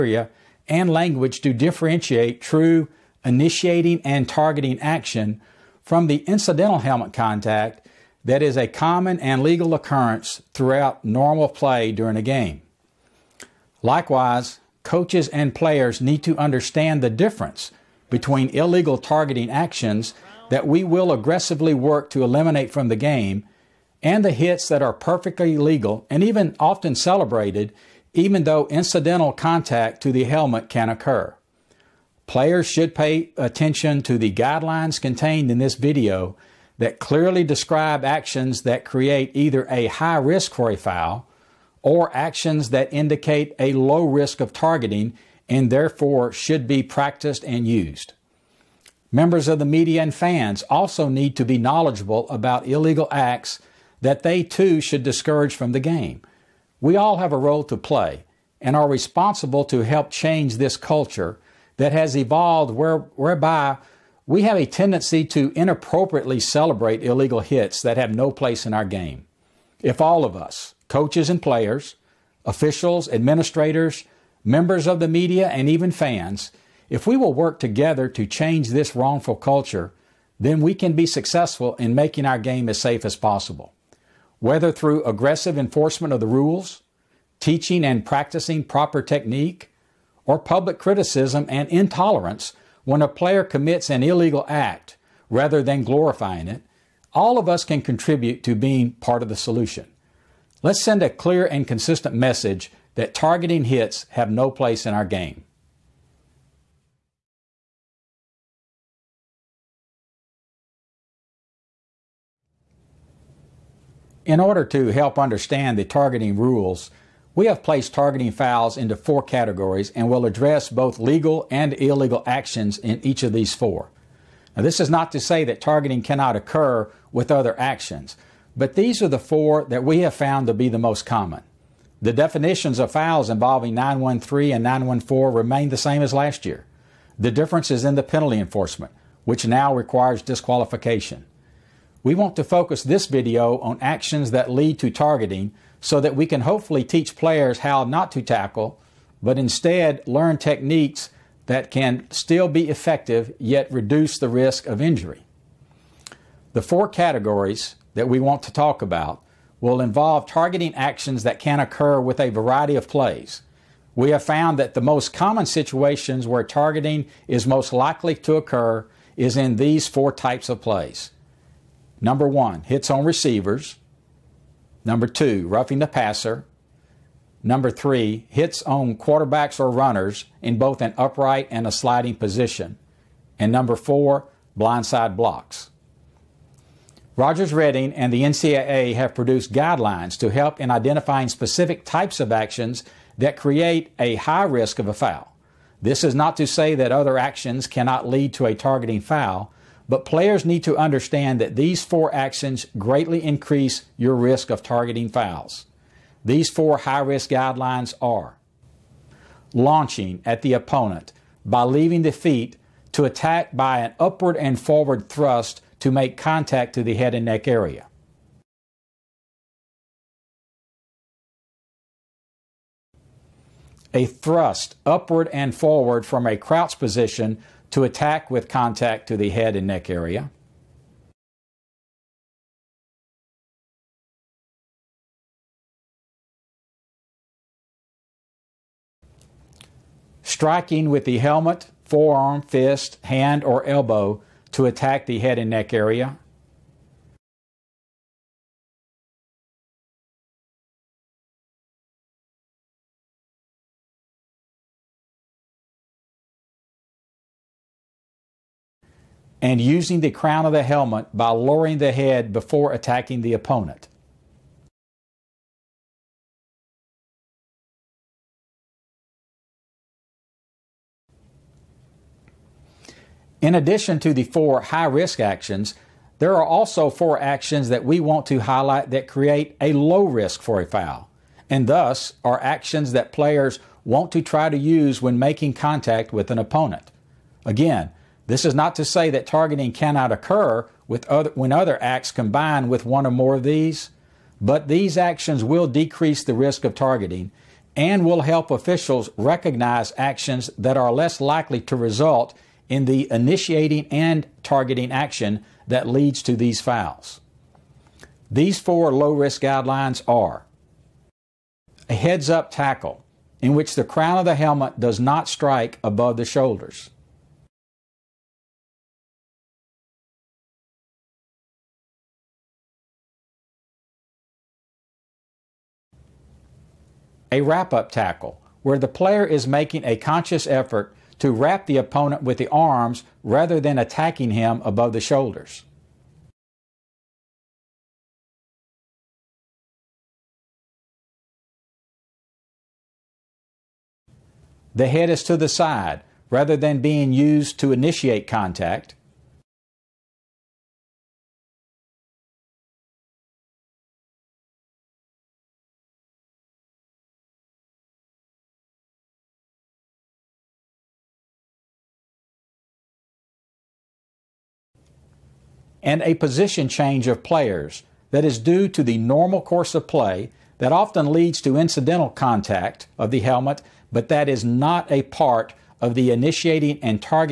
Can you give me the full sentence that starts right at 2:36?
The four categories that we want to talk about will involve targeting actions that can occur with a variety of plays.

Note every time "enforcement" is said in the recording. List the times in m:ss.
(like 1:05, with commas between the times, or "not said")
1:25, 2:18.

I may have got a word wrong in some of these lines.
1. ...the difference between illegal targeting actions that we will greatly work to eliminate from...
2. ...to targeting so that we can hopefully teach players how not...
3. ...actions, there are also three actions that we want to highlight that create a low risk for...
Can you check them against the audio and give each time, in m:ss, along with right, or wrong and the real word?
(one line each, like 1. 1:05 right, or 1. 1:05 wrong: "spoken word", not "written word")
1. 0:17 wrong: "aggressively", not "greatly"
2. 2:24 right
3. 4:35 wrong: "four", not "three".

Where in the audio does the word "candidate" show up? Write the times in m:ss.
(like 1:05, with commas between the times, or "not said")
not said.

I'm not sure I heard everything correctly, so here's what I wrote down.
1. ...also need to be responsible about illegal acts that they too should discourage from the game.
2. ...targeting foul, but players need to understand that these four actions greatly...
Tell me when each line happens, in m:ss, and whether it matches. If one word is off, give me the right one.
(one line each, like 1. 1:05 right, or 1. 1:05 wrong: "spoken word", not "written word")
1. 0:50 wrong: "knowledgeable", not "responsible"
2. 3:18 right.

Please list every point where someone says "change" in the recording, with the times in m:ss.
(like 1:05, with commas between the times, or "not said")
1:00, 1:18, 6:06.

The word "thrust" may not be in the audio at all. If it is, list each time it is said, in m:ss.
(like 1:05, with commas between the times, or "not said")
3:35, 3:44.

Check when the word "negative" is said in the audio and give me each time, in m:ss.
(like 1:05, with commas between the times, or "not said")
not said.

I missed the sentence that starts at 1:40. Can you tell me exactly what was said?
Let's send a clear and consistent message that targeting hits have no place in our game.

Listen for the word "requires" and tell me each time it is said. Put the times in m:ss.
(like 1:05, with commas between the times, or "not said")
2:19.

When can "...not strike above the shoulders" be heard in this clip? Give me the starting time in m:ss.
5:14.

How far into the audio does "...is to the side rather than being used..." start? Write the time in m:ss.
5:45.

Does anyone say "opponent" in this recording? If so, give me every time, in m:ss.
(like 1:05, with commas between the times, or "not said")
3:30, 4:23, 4:46, 5:31.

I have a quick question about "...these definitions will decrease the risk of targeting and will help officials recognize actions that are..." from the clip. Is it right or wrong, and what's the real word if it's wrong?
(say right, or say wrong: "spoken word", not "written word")
wrong: "actions", not "definitions".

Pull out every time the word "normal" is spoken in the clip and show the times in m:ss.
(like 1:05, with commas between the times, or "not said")
0:11, 6:08.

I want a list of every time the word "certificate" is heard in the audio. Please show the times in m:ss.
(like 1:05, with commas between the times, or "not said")
not said.